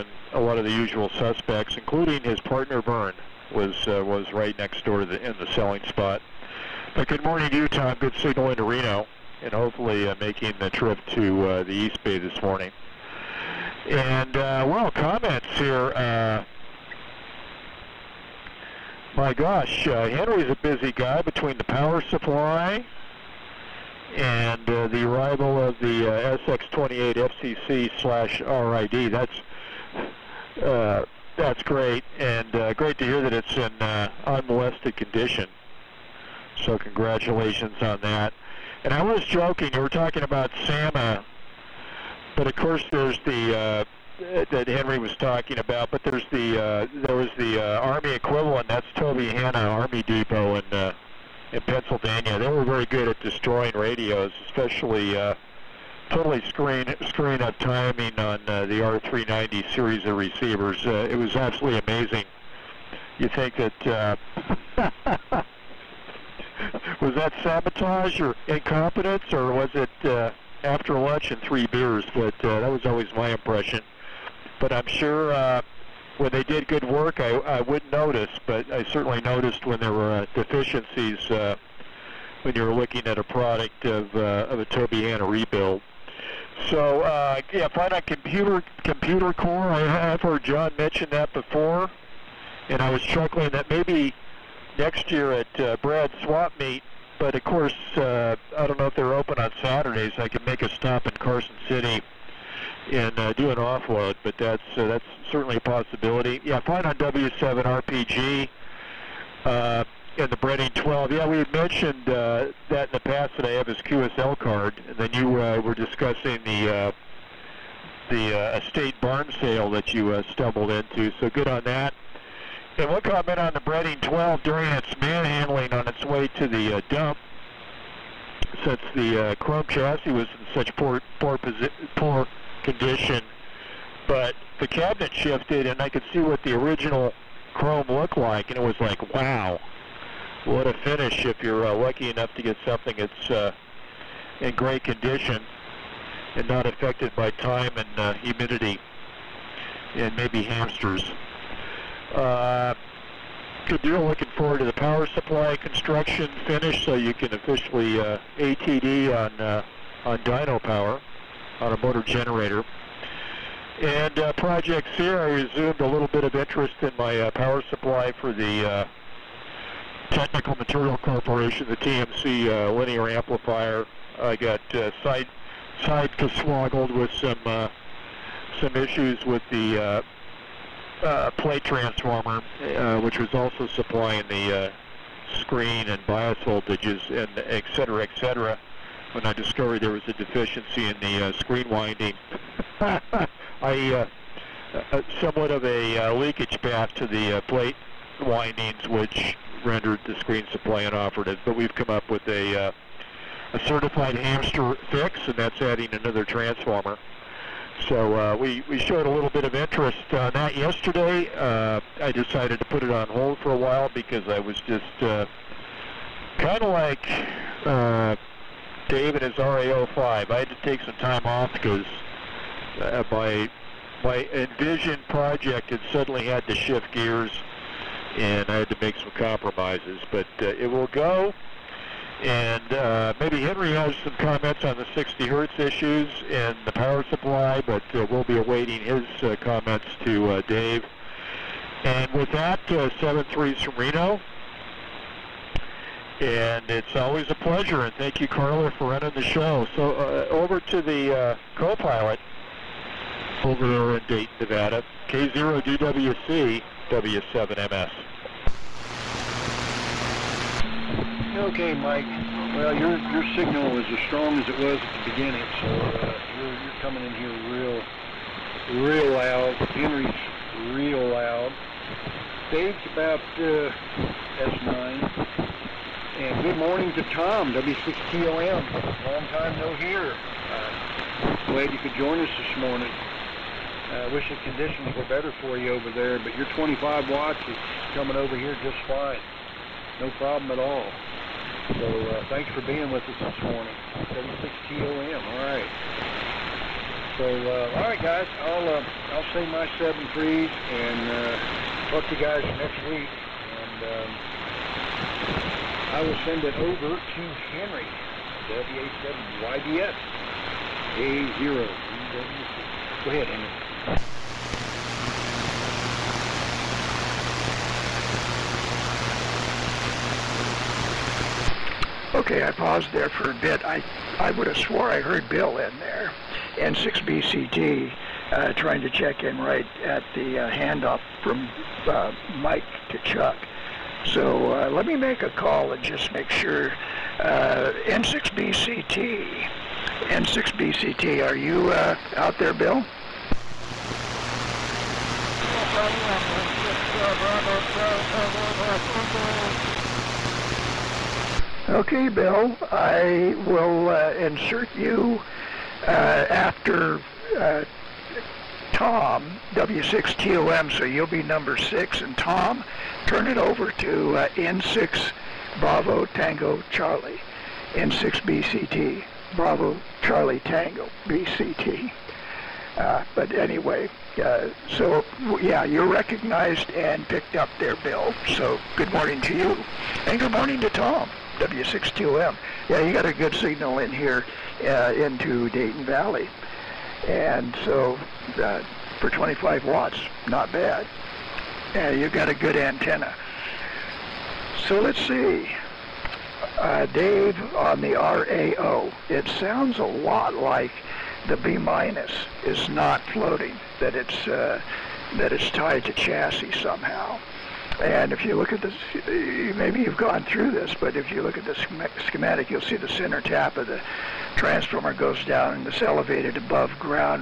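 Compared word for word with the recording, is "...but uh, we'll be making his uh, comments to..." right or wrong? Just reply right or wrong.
wrong.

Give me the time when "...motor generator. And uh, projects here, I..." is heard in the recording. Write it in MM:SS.
02:41.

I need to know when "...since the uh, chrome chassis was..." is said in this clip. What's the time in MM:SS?
02:08.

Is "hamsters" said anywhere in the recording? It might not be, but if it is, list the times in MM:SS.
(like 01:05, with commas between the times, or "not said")
02:30, 03:24.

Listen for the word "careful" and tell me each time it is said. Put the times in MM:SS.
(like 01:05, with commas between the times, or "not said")
not said.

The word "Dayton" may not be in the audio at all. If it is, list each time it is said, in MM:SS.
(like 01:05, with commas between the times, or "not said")
04:14, 06:25.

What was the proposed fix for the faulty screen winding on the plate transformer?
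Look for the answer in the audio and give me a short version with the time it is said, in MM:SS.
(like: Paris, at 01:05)
adding another transformer, at 03:25.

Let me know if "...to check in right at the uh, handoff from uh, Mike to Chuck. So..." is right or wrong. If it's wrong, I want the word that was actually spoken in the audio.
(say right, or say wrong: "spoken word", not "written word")
right.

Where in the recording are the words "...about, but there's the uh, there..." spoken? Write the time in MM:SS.
00:45.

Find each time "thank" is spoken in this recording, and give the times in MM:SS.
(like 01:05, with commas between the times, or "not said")
04:07, 04:52.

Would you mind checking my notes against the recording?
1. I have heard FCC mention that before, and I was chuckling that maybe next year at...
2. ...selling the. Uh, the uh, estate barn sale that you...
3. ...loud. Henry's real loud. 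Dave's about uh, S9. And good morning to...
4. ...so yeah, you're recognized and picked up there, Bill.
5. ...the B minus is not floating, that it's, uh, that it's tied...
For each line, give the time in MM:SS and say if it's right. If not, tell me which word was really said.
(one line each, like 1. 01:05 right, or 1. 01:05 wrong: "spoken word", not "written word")
1. 01:29 wrong: "John", not "FCC"
2. 01:55 wrong: "discussing", not "selling"
3. 04:29 right
4. 06:14 right
5. 06:41 right.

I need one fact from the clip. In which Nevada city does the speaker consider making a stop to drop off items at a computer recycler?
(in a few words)
Carson City.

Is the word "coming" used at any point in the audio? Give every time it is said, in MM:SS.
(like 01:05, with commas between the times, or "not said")
04:26, 04:47.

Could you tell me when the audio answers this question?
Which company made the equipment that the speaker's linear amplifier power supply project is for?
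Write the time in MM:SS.
02:50.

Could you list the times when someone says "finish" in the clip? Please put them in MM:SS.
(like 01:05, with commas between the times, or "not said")
02:20, 02:36.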